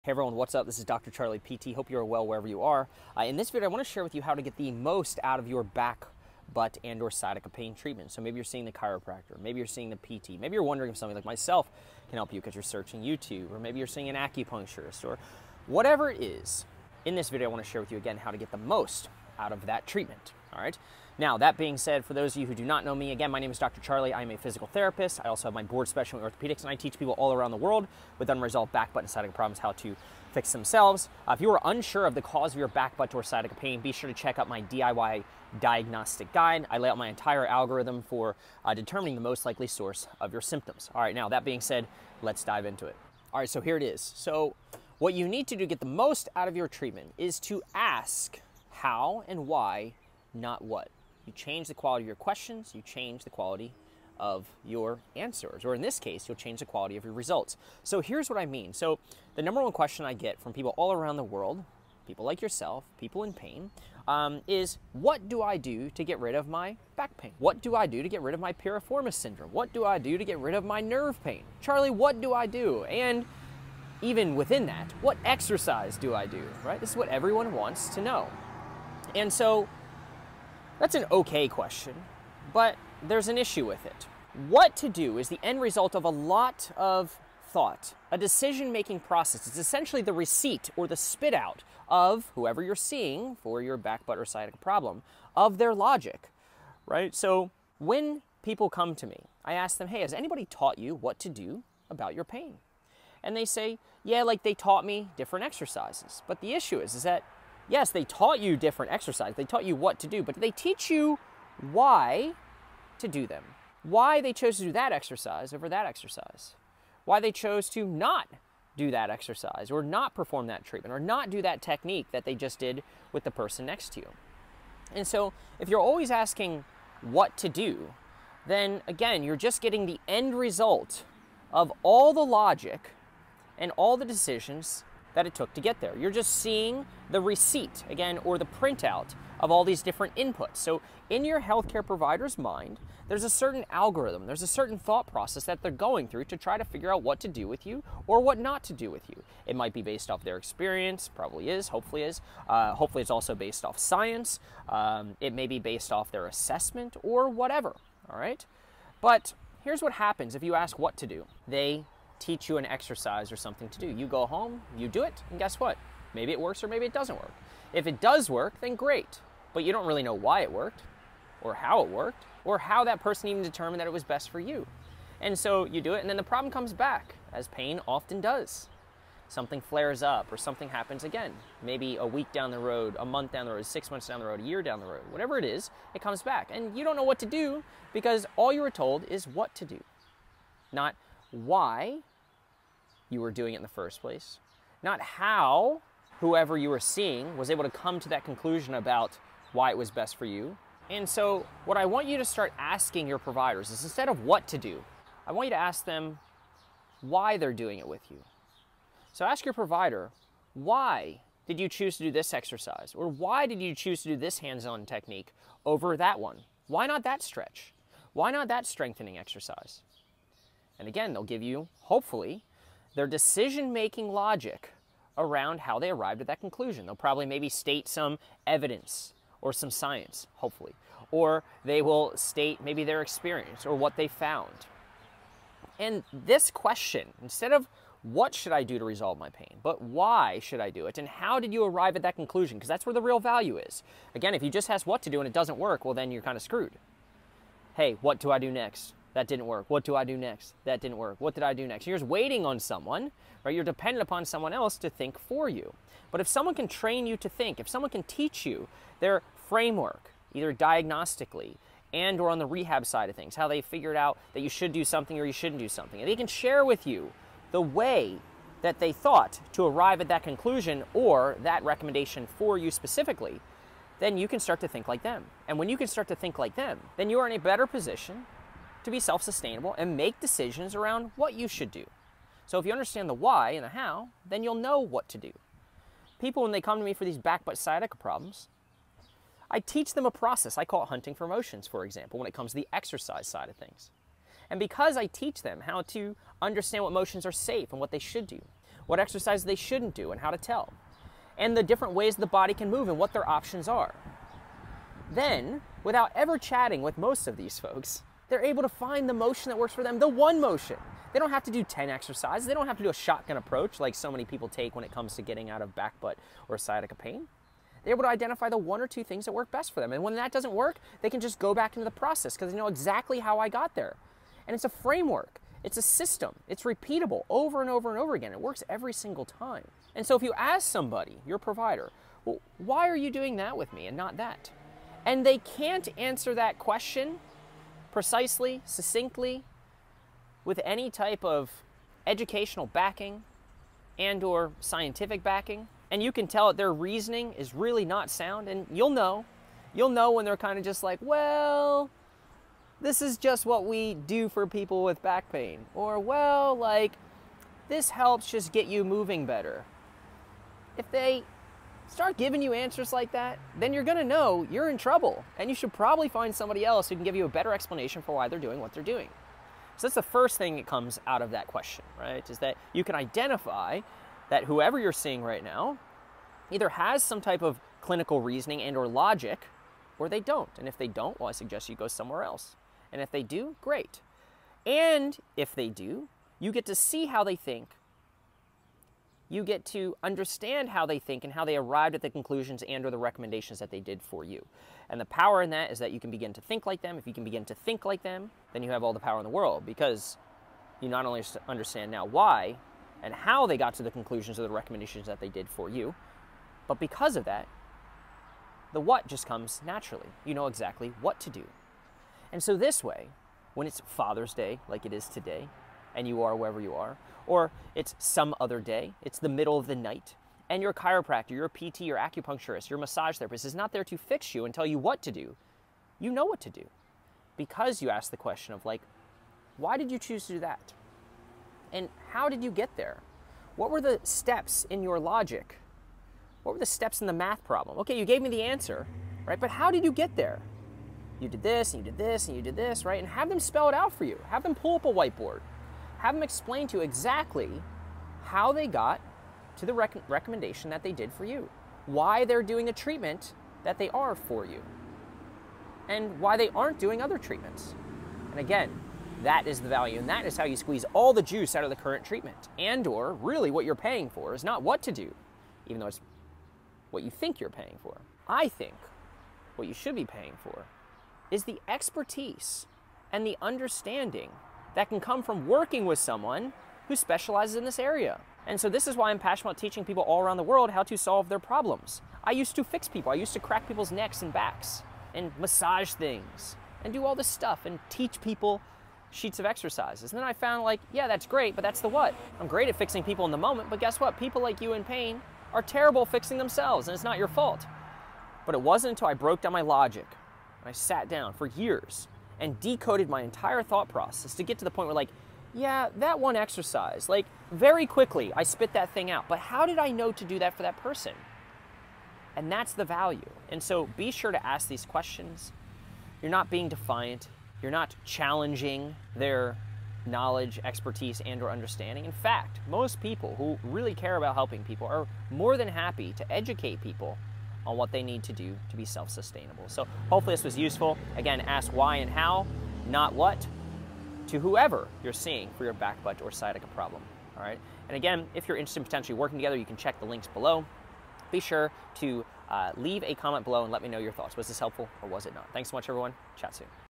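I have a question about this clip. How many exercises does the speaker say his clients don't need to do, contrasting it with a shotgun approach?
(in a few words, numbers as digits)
10.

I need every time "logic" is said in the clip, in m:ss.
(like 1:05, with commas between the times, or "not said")
1:35, 2:12, 3:44, 6:18, 7:14, 8:19.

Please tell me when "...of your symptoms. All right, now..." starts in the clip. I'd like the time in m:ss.
0:40.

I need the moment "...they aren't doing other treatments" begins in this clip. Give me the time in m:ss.
7:36.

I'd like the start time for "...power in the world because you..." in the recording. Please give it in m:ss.
6:38.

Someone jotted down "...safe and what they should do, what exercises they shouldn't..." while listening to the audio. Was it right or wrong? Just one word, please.
right.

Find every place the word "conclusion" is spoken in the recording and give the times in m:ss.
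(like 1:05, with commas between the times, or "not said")
3:18, 3:46, 4:02, 4:30, 6:32, 6:43.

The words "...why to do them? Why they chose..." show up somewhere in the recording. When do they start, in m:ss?
1:51.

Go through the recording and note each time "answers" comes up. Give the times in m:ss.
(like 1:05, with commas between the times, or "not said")
0:55, 5:35, 6:02, 7:18.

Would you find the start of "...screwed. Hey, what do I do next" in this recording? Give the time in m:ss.
4:06.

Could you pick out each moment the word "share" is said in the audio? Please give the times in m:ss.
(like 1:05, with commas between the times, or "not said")
0:03, 0:17, 4:26.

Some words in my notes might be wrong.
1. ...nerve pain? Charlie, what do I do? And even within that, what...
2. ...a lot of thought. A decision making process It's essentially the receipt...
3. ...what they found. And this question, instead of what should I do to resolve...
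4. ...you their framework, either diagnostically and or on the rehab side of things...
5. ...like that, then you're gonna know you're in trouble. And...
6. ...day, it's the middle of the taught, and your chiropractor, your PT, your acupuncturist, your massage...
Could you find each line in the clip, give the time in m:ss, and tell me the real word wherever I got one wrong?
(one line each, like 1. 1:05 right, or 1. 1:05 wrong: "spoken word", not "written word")
1. 1:10 right
2. 1:26 right
3. 3:53 right
4. 4:18 right
5. 6:02 right
6. 6:58 wrong: "night", not "taught".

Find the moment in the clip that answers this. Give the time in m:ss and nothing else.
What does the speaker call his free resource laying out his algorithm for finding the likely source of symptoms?
0:34.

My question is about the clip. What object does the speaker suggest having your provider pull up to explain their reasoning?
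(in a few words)
A whiteboard.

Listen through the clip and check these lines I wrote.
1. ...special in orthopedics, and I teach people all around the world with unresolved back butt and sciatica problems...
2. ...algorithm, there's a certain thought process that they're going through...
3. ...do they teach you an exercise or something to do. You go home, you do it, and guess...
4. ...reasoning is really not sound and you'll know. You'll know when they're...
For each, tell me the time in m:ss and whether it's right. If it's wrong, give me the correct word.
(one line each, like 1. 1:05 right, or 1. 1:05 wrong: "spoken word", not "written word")
1. 0:25 right
2. 2:23 right
3. 2:41 right
4. 5:46 right.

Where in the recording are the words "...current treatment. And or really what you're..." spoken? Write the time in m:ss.
7:41.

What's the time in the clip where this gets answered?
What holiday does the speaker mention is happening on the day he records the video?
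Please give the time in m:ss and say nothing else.
6:53.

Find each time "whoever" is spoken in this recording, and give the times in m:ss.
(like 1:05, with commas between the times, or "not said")
1:32, 3:16, 6:14, 8:54.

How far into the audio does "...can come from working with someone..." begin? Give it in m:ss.
7:54.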